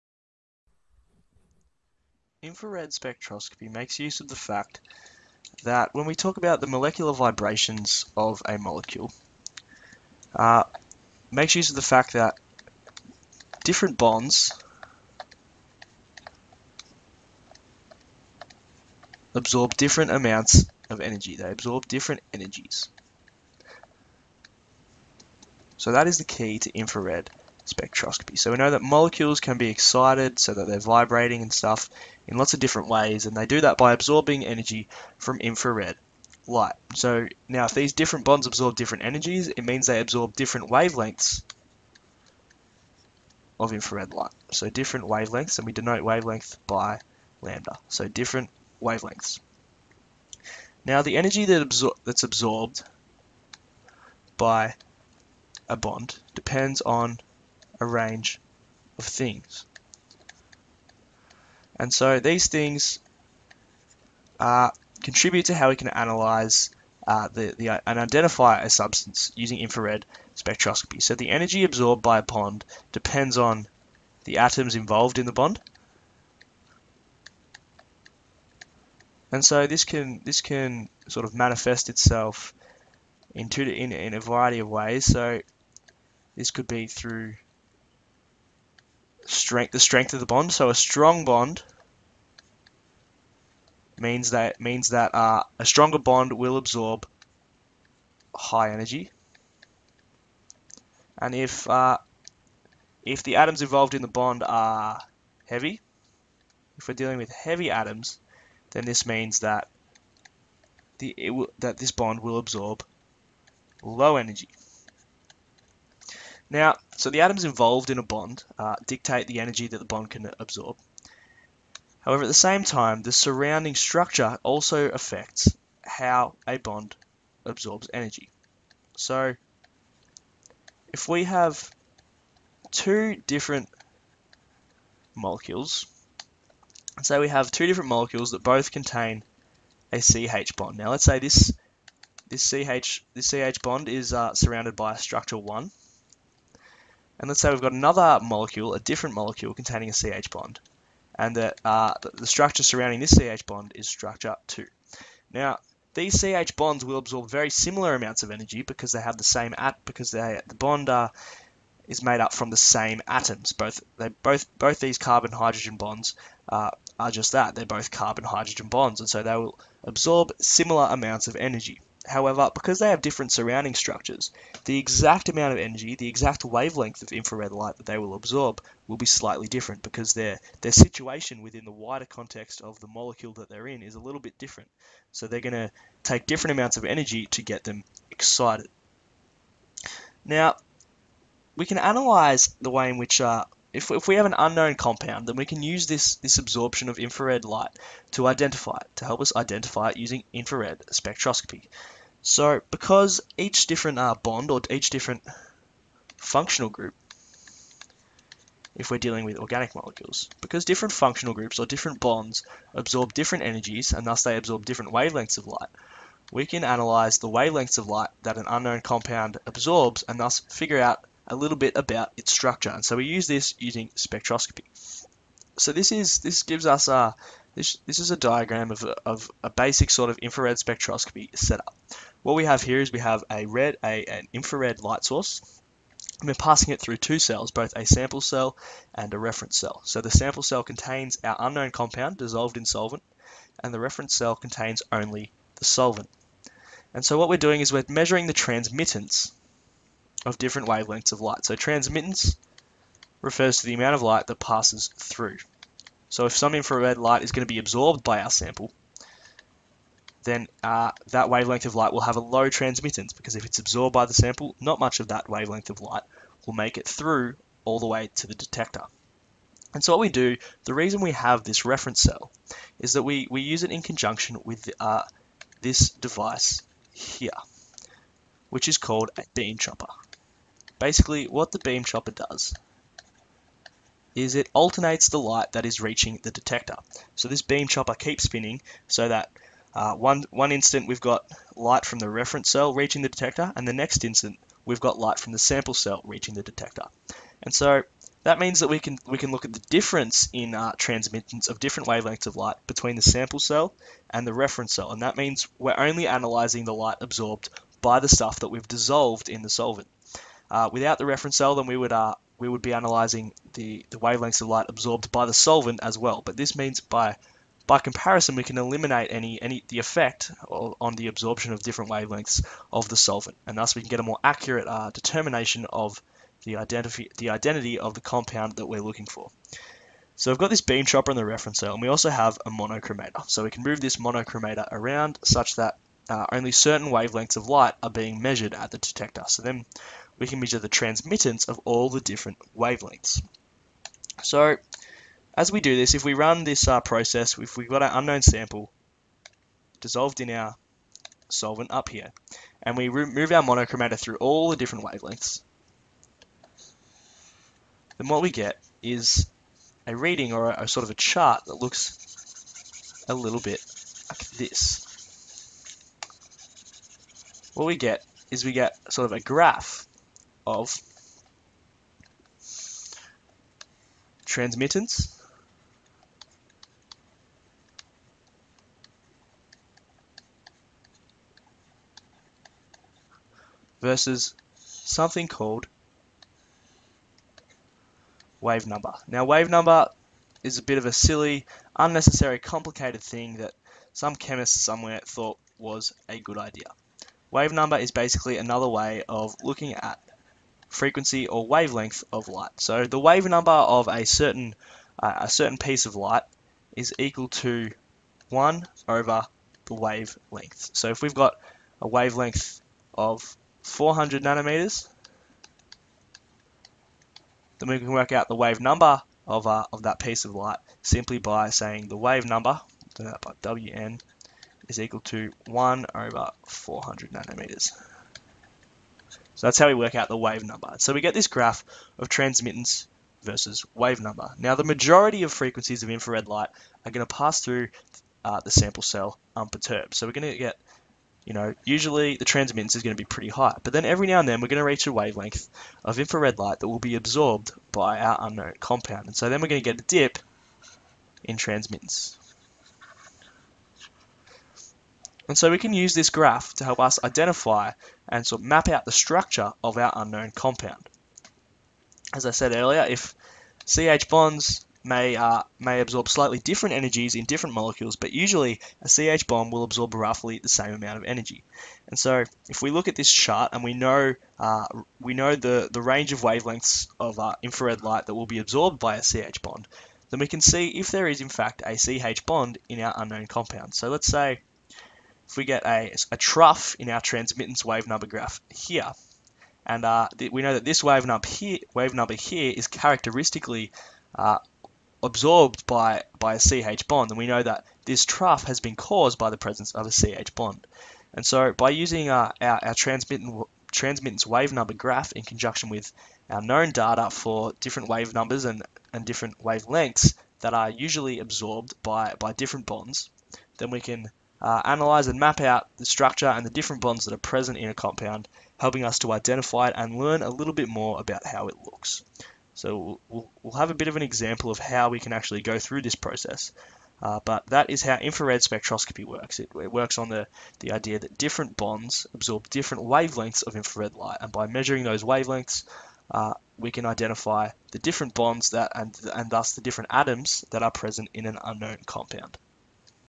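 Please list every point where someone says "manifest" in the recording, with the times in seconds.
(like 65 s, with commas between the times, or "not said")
81 s.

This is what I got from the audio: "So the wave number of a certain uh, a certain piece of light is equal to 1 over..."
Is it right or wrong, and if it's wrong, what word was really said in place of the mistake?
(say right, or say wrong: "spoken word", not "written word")
right.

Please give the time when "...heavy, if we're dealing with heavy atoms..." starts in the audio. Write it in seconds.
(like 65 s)
105 s.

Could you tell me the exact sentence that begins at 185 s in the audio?
So they're going to take different amounts of energy to get them excited.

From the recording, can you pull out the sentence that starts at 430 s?
So we get this graph of transmittance versus wave number.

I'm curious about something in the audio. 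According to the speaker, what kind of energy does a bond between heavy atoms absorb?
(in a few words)
Low energy.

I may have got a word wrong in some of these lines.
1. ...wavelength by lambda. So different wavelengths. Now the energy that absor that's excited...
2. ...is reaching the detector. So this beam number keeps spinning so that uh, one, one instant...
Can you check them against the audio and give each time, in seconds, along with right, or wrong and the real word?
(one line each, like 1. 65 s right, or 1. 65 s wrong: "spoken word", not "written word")
1. 46 s wrong: "absorbed", not "excited"
2. 285 s wrong: "chopper", not "number".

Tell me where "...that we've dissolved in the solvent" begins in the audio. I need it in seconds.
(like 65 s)
308 s.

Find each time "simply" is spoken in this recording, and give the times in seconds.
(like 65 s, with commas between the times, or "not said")
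420 s.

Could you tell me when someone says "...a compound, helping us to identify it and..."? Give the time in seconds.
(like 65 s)
517 s.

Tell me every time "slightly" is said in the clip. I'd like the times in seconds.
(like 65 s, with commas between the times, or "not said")
179 s, 466 s.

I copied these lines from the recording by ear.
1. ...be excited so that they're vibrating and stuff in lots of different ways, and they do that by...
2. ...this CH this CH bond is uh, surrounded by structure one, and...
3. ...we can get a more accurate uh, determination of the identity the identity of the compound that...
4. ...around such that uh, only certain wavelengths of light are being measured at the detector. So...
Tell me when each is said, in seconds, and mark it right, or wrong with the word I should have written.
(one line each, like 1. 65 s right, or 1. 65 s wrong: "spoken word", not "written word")
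1. 29 s right
2. 142 s right
3. 323 s right
4. 334 s right.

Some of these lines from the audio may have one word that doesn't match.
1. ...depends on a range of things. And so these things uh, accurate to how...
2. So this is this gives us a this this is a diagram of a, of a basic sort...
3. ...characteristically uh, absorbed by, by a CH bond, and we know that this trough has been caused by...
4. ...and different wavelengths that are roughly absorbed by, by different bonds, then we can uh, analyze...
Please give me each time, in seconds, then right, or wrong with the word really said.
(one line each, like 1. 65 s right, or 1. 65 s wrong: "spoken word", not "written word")
1. 56 s wrong: "contribute", not "accurate"
2. 225 s right
3. 492 s right
4. 508 s wrong: "usually", not "roughly".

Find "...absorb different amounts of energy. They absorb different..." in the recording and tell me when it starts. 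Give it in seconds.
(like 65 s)
19 s.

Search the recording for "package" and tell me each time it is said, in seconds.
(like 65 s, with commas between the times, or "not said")
not said.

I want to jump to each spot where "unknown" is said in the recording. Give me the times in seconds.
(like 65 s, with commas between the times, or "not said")
194 s, 218 s, 241 s, 347 s, 448 s, 459 s, 482 s, 541 s.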